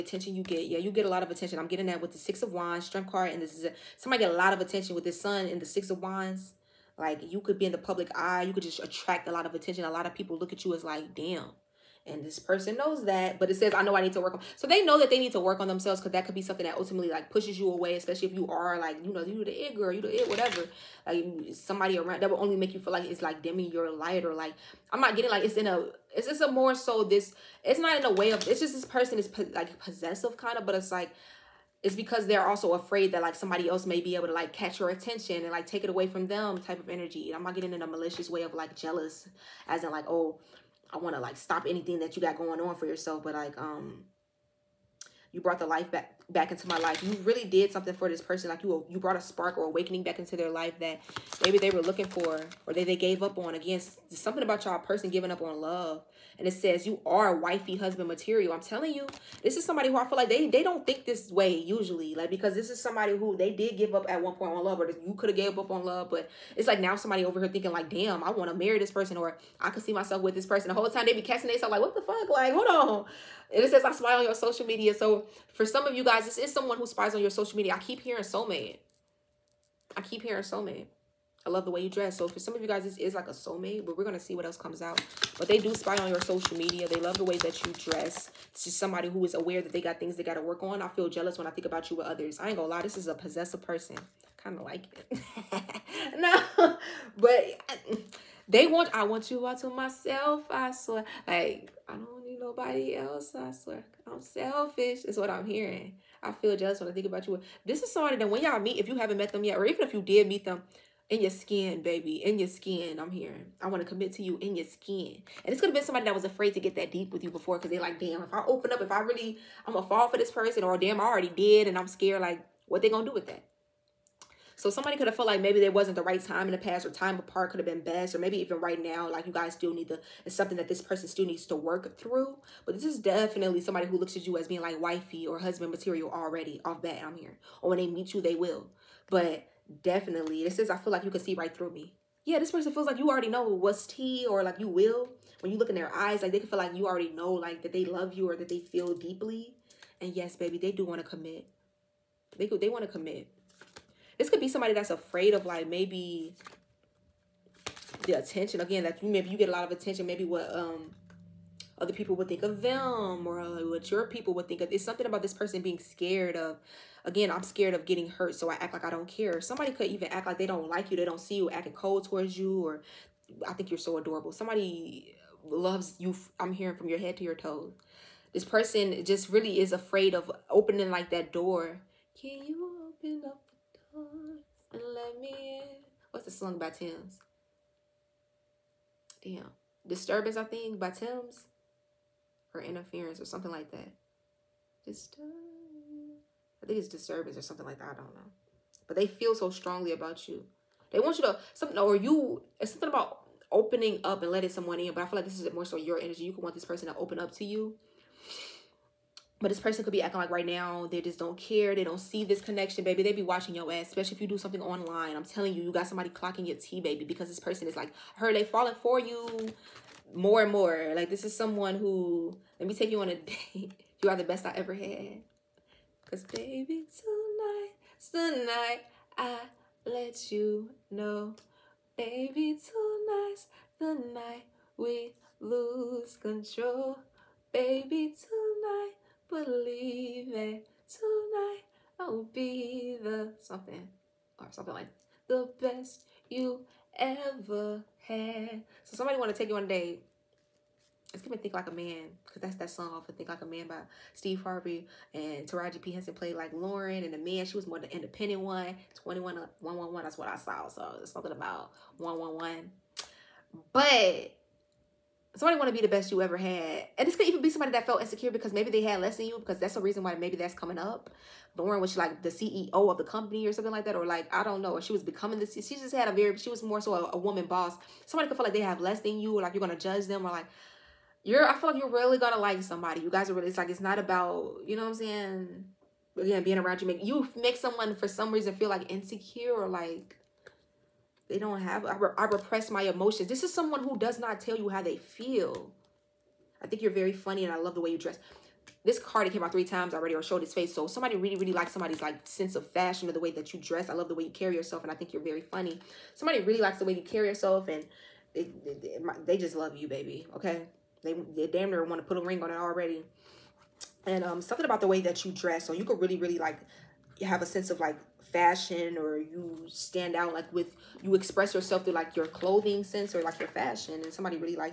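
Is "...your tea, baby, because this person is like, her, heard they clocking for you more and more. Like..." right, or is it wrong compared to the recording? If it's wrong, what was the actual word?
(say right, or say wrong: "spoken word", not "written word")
wrong: "falling", not "clocking".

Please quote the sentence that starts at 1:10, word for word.
The whole time they be casting themselves like, what the fuck?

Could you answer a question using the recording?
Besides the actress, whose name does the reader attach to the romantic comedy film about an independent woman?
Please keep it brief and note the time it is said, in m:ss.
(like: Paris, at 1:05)
Steve Harvey, at 4:14.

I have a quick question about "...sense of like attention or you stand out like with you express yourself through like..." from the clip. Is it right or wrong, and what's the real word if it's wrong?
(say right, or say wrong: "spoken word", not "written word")
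wrong: "fashion", not "attention".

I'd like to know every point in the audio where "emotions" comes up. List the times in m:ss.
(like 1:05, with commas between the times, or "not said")
4:52.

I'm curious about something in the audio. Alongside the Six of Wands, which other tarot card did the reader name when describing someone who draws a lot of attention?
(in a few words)
Strength.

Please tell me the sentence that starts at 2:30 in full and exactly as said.
And yes, baby, they do want to commit.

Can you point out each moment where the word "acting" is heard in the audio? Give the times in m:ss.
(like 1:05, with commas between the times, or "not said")
2:51, 3:30.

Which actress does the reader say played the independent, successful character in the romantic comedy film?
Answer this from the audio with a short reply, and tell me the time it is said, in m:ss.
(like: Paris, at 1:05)
Taraji P Henson, at 4:15.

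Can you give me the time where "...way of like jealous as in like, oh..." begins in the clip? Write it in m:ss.
0:38.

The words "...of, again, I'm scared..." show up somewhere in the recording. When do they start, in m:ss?
2:46.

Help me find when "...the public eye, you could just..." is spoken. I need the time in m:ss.
0:07.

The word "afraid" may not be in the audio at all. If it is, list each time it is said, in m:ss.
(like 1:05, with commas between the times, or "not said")
0:32, 1:56, 2:34, 2:59.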